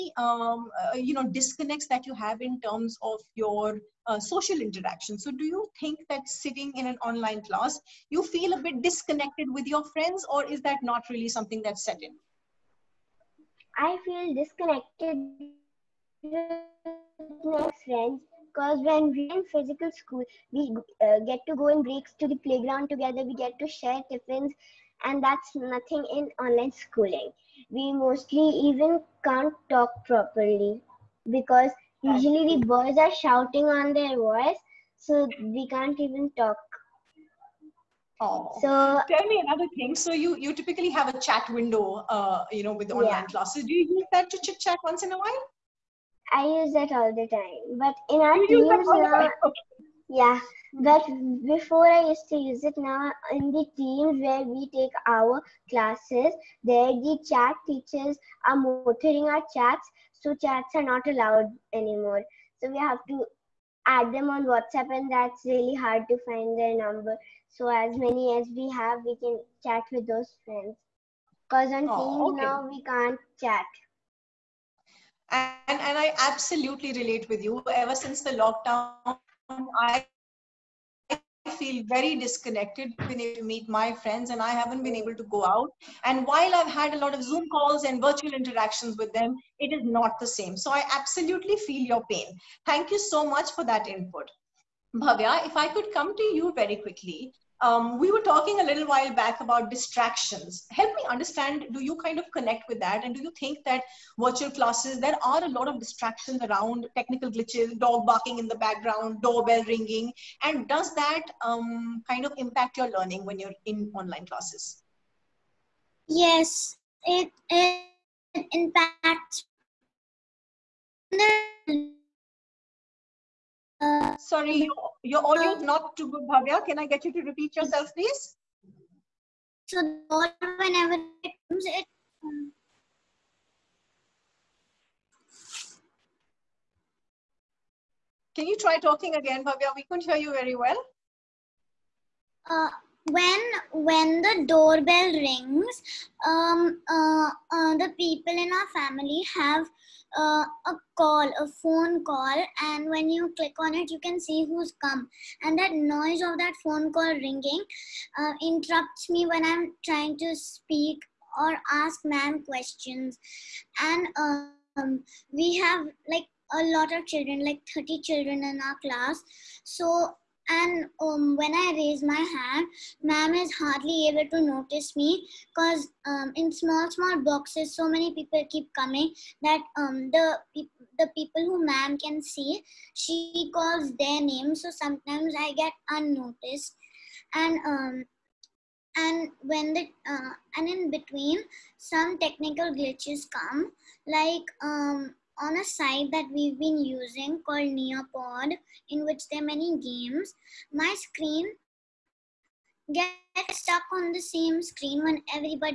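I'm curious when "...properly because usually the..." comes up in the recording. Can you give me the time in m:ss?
0:30.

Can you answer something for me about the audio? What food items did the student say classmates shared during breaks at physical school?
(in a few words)
tiffins.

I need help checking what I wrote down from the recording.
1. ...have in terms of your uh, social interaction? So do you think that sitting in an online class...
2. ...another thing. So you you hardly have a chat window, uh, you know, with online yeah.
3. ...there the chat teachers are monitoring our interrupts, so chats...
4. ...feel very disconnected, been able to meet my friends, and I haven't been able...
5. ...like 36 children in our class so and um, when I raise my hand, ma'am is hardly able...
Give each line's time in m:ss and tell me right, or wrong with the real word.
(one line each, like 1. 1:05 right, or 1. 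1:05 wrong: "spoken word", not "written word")
1. 0:02 right
2. 0:39 wrong: "typically", not "hardly"
3. 0:56 wrong: "chats", not "interrupts"
4. 1:21 right
5. 2:47 wrong: "30", not "36".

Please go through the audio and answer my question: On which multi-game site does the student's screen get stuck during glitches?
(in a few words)
Nearpod.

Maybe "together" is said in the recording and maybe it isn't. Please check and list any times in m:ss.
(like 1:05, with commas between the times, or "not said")
0:22.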